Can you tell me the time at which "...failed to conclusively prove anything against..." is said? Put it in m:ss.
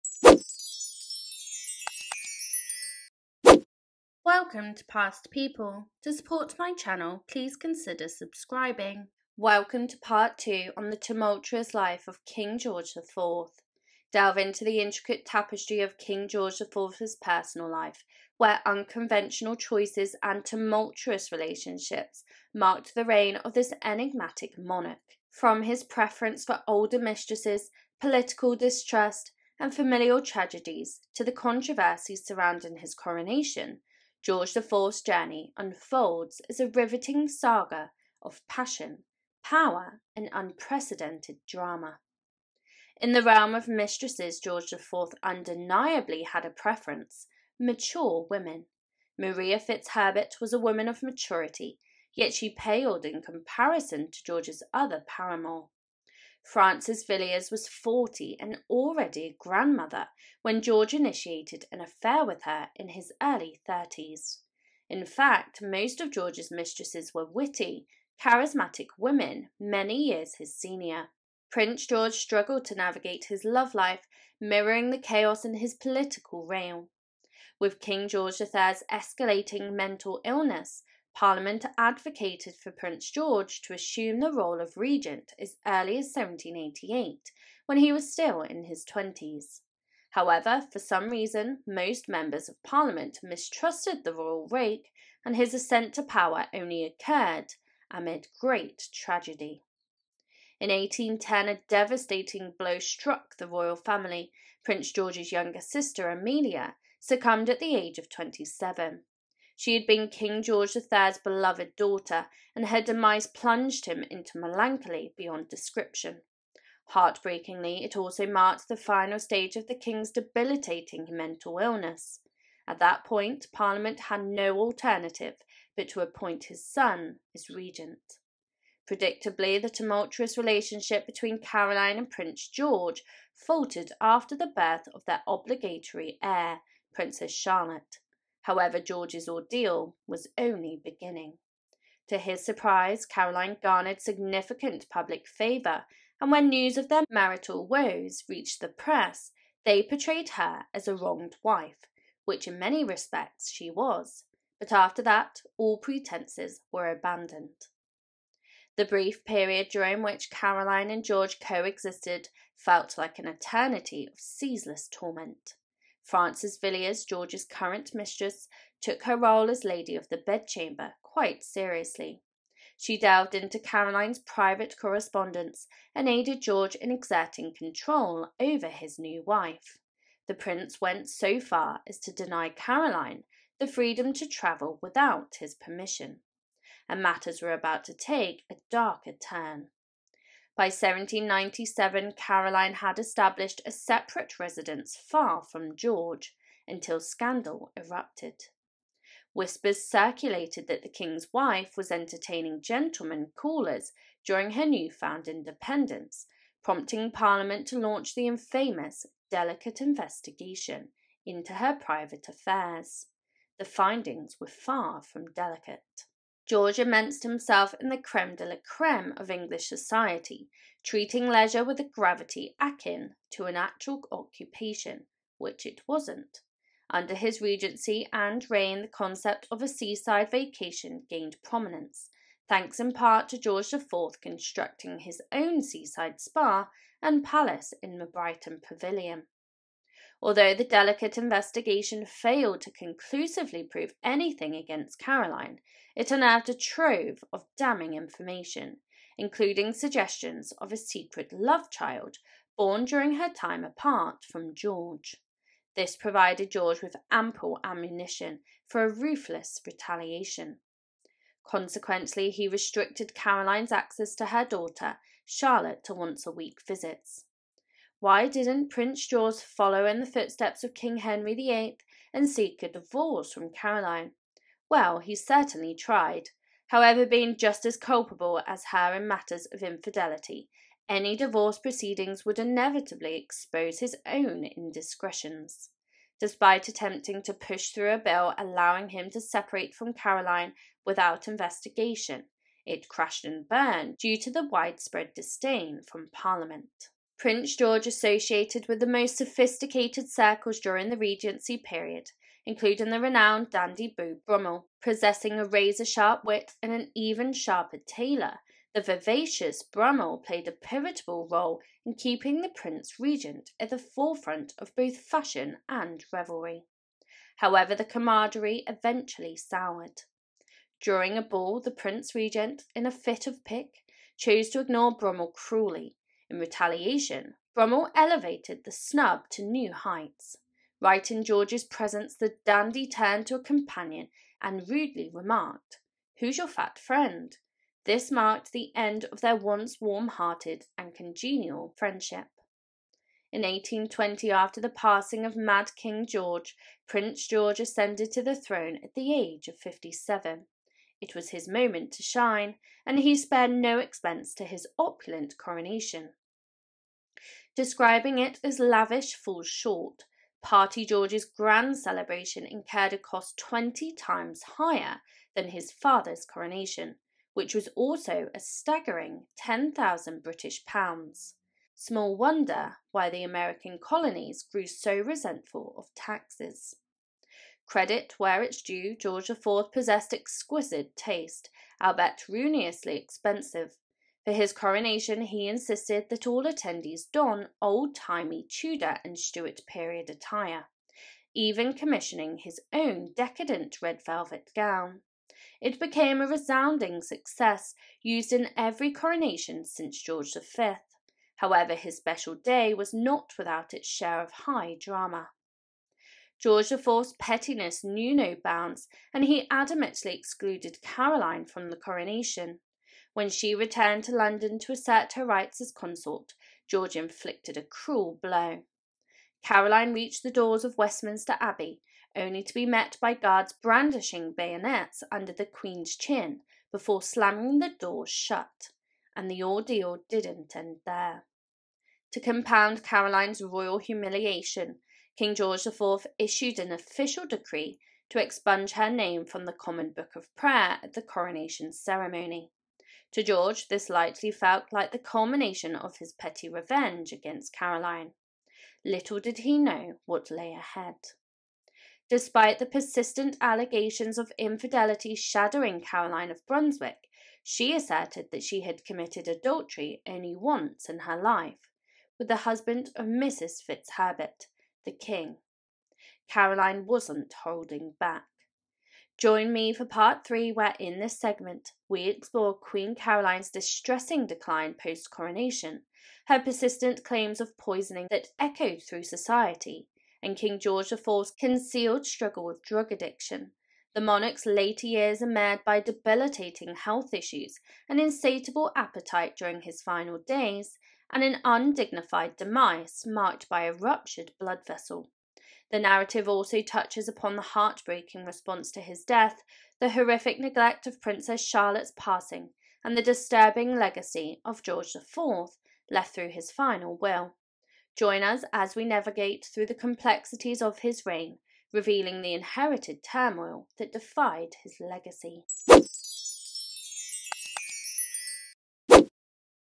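4:02.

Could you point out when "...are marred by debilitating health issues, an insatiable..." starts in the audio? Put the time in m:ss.
8:05.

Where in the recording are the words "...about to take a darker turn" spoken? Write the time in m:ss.
3:07.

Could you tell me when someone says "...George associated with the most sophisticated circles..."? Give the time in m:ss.
4:57.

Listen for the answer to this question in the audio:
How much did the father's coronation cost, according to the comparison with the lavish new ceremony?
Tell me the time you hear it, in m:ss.
6:09.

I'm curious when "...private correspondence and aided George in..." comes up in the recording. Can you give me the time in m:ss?
2:54.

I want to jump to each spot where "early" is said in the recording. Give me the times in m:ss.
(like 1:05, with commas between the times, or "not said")
1:03, 1:25.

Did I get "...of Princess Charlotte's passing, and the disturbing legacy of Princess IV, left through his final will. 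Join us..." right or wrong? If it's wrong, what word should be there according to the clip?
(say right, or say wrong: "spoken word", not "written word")
wrong: "George", not "Princess".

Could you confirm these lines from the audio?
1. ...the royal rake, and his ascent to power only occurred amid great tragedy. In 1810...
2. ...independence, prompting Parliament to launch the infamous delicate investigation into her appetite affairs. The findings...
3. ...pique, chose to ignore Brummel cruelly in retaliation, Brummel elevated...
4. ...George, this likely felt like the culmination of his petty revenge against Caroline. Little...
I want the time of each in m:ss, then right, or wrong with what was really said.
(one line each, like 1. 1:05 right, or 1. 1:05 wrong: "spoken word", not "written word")
1. 1:34 right
2. 3:25 wrong: "private", not "appetite"
3. 5:23 right
4. 7:23 right.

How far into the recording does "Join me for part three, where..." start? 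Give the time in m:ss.
7:49.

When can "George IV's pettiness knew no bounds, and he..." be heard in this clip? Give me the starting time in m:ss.
6:46.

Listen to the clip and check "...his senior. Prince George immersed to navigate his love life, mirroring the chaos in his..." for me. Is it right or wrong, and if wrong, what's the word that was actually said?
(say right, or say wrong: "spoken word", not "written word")
wrong: "struggled", not "immersed".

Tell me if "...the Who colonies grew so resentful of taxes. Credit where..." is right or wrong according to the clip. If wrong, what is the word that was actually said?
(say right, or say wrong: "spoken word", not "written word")
wrong: "American", not "Who".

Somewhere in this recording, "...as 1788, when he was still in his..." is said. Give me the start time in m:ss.
1:25.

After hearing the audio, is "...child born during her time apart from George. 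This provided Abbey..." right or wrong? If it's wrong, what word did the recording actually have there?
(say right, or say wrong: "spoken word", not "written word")
wrong: "George", not "Abbey".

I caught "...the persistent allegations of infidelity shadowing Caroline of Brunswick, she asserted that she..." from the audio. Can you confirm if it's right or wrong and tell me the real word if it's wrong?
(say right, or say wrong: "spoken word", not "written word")
right.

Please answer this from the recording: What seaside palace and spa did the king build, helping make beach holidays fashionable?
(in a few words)
Brighton Pavilion.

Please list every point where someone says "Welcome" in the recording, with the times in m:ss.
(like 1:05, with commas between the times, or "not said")
0:04, 0:09.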